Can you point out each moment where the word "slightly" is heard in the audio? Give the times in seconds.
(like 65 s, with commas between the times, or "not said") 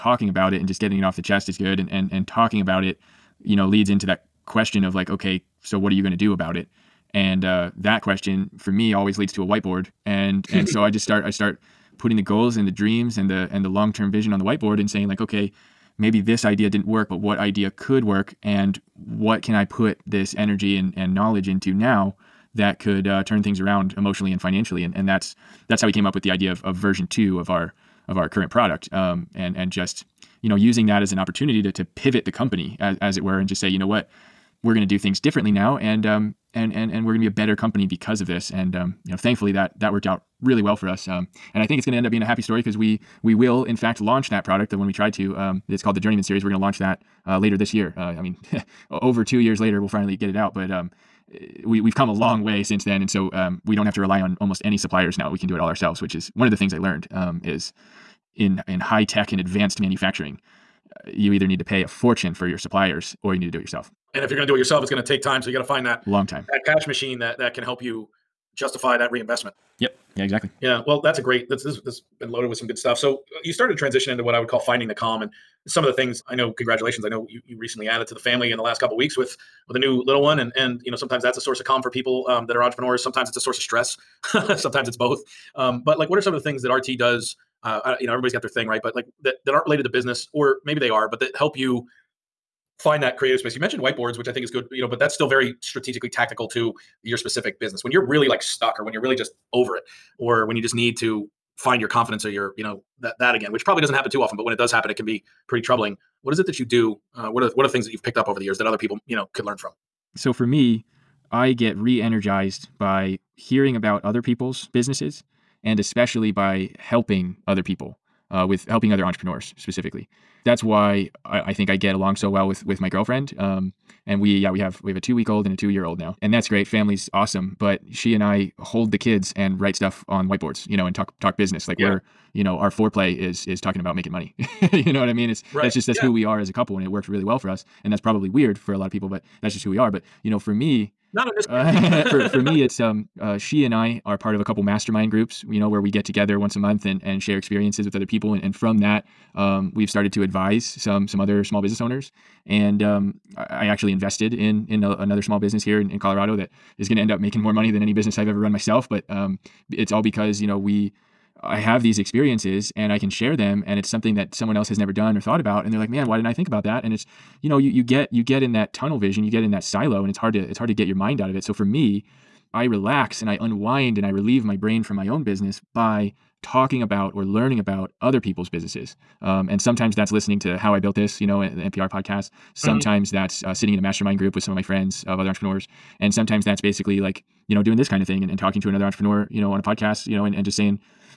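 not said.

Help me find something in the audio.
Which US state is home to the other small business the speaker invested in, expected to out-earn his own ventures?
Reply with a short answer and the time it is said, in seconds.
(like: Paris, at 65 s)
Colorado, at 155 s.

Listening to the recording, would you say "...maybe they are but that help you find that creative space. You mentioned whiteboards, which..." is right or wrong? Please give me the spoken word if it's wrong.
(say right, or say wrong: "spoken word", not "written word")
right.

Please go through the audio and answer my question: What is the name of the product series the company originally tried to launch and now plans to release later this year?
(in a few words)
Journeyman series.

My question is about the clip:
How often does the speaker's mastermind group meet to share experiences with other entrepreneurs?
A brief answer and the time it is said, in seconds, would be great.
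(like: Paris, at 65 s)
Once a month, at 146 s.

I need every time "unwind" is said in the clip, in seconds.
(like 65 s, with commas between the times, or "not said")
173 s.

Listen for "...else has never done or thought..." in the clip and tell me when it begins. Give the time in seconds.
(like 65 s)
164 s.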